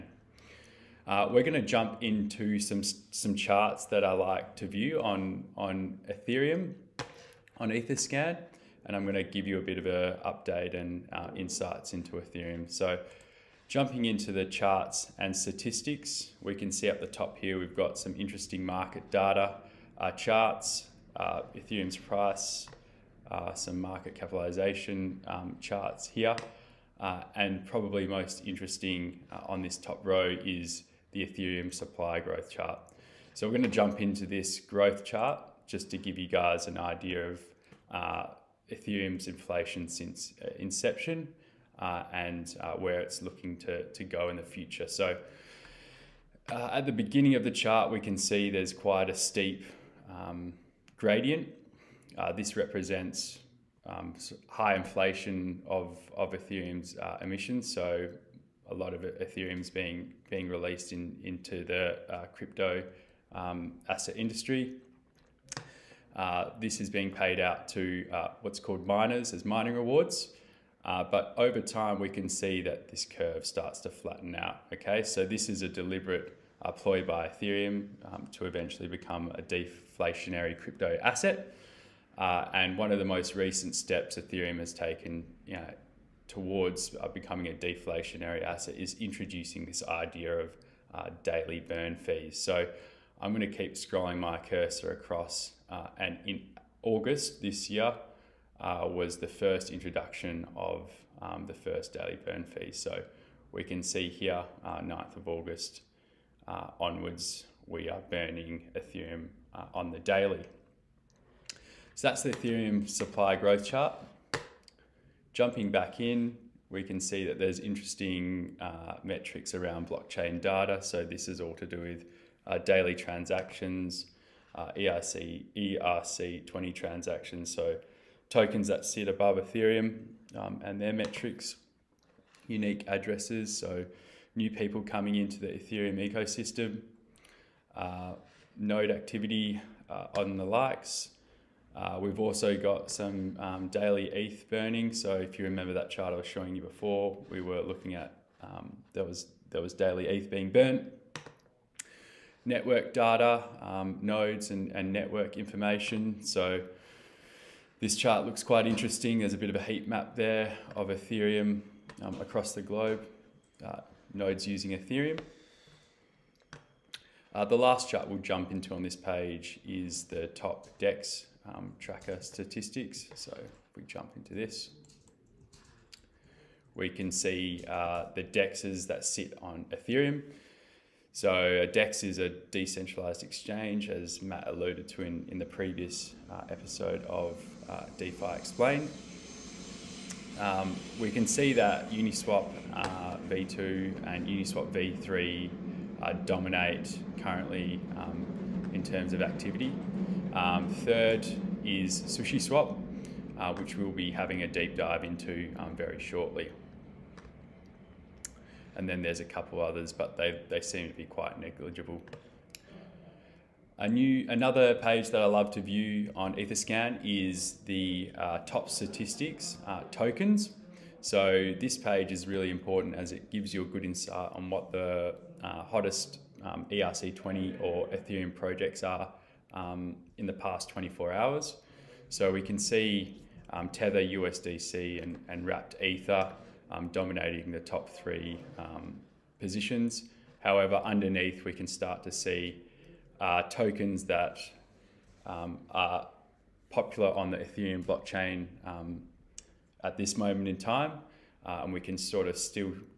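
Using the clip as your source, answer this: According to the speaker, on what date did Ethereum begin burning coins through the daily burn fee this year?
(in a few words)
9th of August.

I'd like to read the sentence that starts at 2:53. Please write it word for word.
So if we jump into this, we can see uh, the DEXs that sit on Ethereum.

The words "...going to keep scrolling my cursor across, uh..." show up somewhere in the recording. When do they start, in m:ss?
1:33.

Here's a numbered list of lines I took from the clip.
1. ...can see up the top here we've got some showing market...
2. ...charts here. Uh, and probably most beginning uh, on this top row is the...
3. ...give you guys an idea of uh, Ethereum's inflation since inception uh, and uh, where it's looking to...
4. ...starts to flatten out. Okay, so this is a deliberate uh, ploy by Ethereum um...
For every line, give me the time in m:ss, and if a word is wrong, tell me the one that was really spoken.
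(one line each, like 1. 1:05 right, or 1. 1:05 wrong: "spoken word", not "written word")
1. 0:16 wrong: "interesting", not "showing"
2. 0:25 wrong: "interesting", not "beginning"
3. 0:35 right
4. 1:13 right.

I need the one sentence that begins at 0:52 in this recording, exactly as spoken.
Uh, this represents um, high inflation of, of Ethereum's uh, emissions.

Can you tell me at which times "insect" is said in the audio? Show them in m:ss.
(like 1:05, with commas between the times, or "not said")
not said.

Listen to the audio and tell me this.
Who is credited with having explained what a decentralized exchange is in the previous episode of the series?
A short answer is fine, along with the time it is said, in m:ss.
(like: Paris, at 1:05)
Matt, at 3:04.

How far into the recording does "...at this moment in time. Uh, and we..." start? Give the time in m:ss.
4:09.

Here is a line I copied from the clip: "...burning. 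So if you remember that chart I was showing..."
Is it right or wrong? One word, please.
right.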